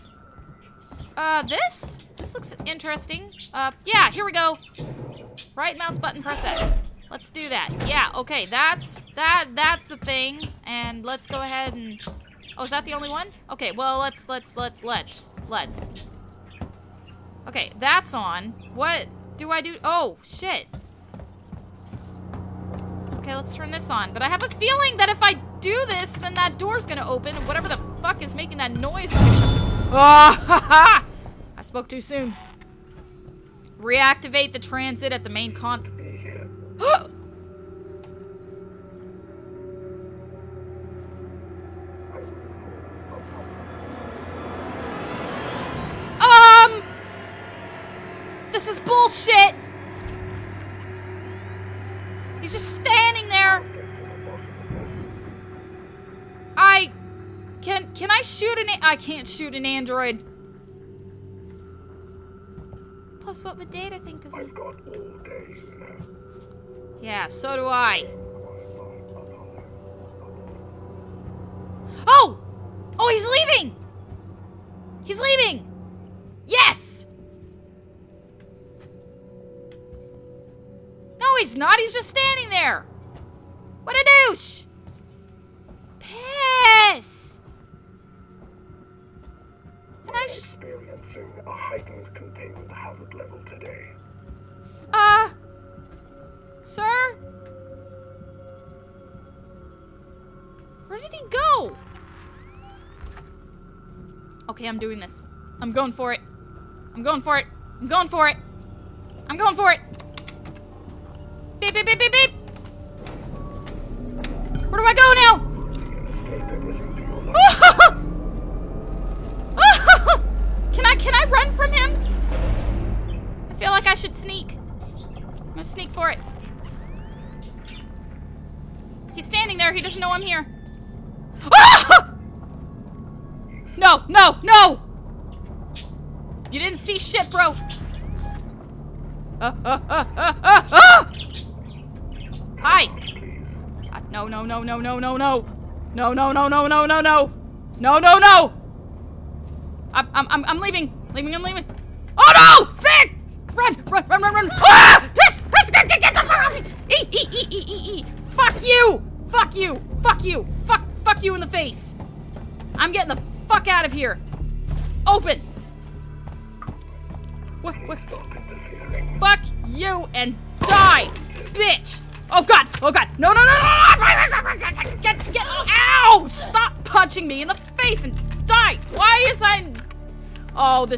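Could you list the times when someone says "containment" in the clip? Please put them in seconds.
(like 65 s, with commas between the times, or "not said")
92 s.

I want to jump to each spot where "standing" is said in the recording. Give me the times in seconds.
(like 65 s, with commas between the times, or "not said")
52 s, 82 s, 129 s.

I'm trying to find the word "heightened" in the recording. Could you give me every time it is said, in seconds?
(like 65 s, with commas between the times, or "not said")
91 s.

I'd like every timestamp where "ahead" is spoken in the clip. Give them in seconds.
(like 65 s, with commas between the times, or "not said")
11 s.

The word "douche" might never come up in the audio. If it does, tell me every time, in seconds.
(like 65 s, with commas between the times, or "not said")
84 s.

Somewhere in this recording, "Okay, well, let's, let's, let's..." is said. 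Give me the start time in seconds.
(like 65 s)
13 s.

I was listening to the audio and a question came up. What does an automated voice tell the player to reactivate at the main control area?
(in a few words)
the transit.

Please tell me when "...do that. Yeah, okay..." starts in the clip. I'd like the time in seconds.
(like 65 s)
7 s.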